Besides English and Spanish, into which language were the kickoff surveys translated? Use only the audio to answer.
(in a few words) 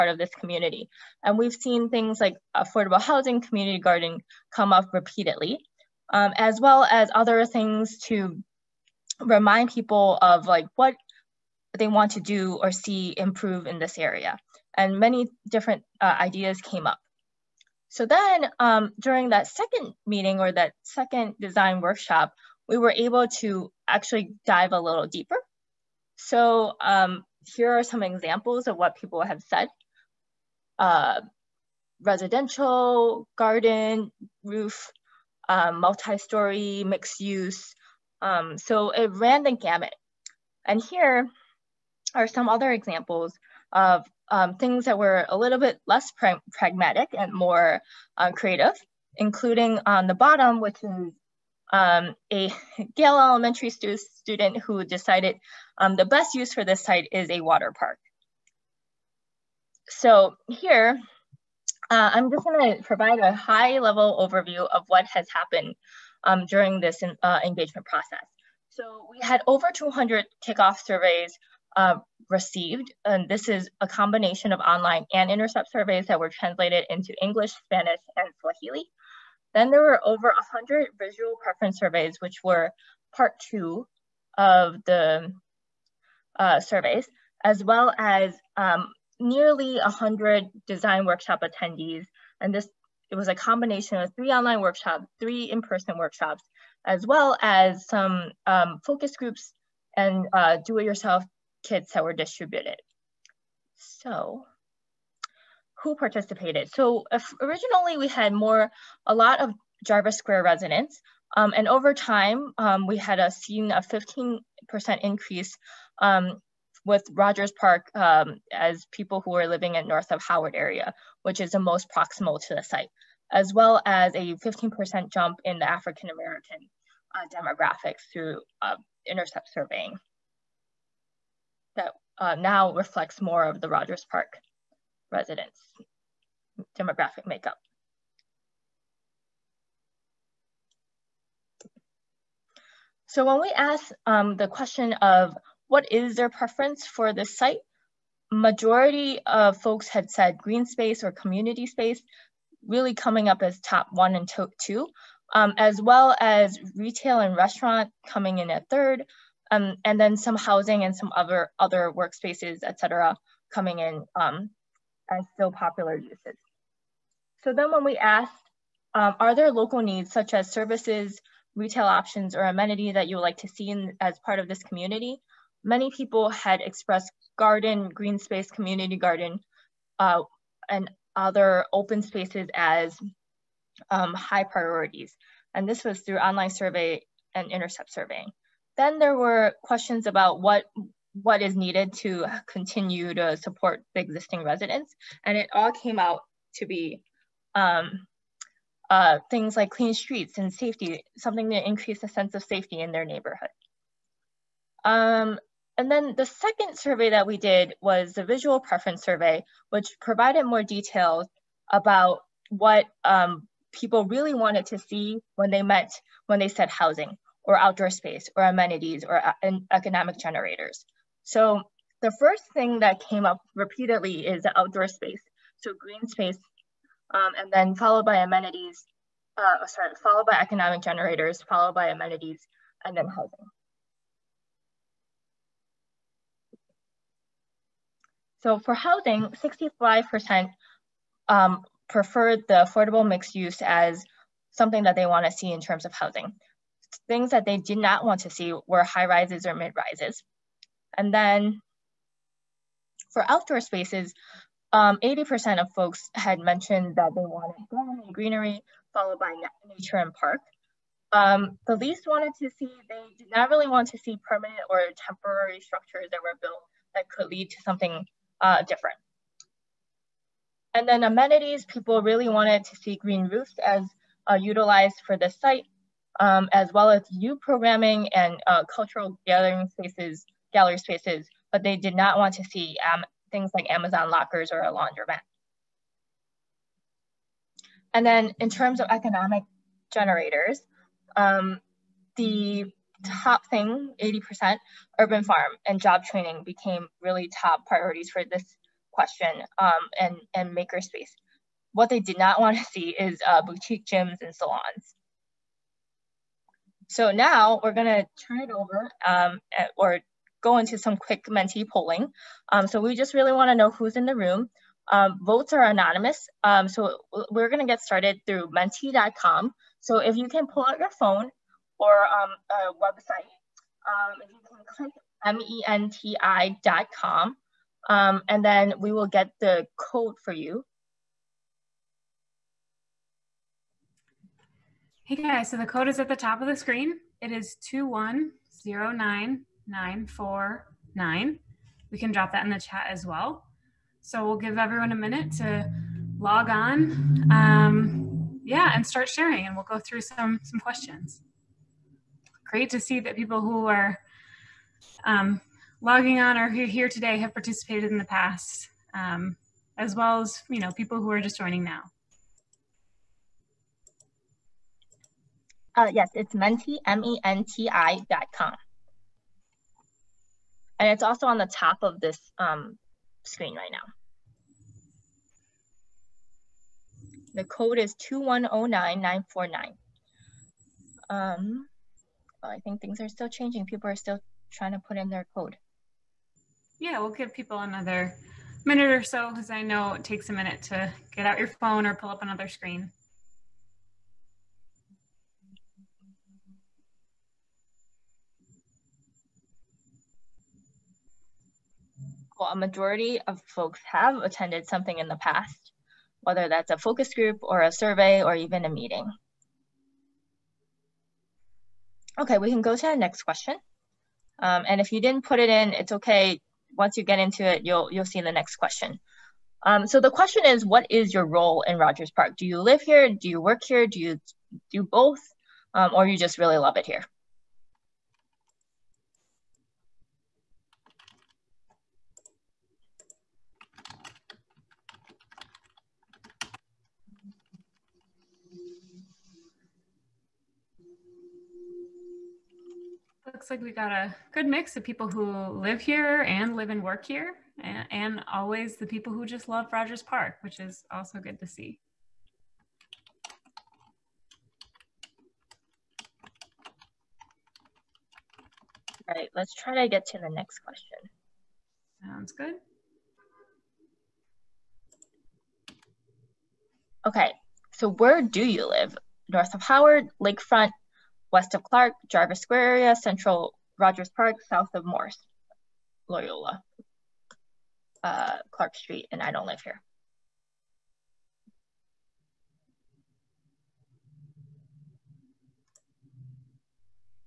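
Swahili.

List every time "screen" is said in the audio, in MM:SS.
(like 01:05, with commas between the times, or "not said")
05:36, 06:13, 06:32.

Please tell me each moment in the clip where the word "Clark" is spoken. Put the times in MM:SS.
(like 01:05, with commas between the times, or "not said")
07:51, 07:58.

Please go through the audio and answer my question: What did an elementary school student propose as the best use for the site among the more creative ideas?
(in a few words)
water park.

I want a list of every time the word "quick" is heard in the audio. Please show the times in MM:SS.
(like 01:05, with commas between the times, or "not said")
05:10.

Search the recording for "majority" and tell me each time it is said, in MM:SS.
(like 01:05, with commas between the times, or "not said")
02:28, 06:42.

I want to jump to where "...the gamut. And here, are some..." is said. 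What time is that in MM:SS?
00:39.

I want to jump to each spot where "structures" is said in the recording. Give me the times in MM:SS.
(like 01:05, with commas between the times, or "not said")
04:25.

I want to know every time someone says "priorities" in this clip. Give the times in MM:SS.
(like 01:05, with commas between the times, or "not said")
03:04, 04:57.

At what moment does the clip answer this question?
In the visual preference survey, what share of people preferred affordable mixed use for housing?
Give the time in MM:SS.
03:59.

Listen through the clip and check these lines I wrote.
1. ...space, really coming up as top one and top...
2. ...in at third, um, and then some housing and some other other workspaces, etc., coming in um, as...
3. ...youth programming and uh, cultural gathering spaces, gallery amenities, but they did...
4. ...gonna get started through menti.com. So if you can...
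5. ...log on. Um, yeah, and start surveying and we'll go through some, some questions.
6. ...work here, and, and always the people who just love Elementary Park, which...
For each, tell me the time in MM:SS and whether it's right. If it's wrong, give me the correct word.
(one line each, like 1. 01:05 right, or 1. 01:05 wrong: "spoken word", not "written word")
1. 02:31 right
2. 02:38 right
3. 04:37 wrong: "spaces", not "amenities"
4. 05:17 right
5. 05:46 wrong: "sharing", not "surveying"
6. 07:26 wrong: "Rogers", not "Elementary".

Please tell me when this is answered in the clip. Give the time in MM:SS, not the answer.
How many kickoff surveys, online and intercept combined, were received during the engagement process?
01:09.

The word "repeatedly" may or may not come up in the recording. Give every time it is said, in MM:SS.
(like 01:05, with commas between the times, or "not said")
00:04, 03:43.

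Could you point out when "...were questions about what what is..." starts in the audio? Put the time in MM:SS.
03:09.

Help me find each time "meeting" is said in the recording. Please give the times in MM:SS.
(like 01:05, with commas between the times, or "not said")
00:20, 06:48.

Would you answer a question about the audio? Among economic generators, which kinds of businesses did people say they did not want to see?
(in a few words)
boutique gyms and salons.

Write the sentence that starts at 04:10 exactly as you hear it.
And then for outdoor spaces, 80% um, of folks had mentioned that they wanted garden and greenery, followed by nature and park.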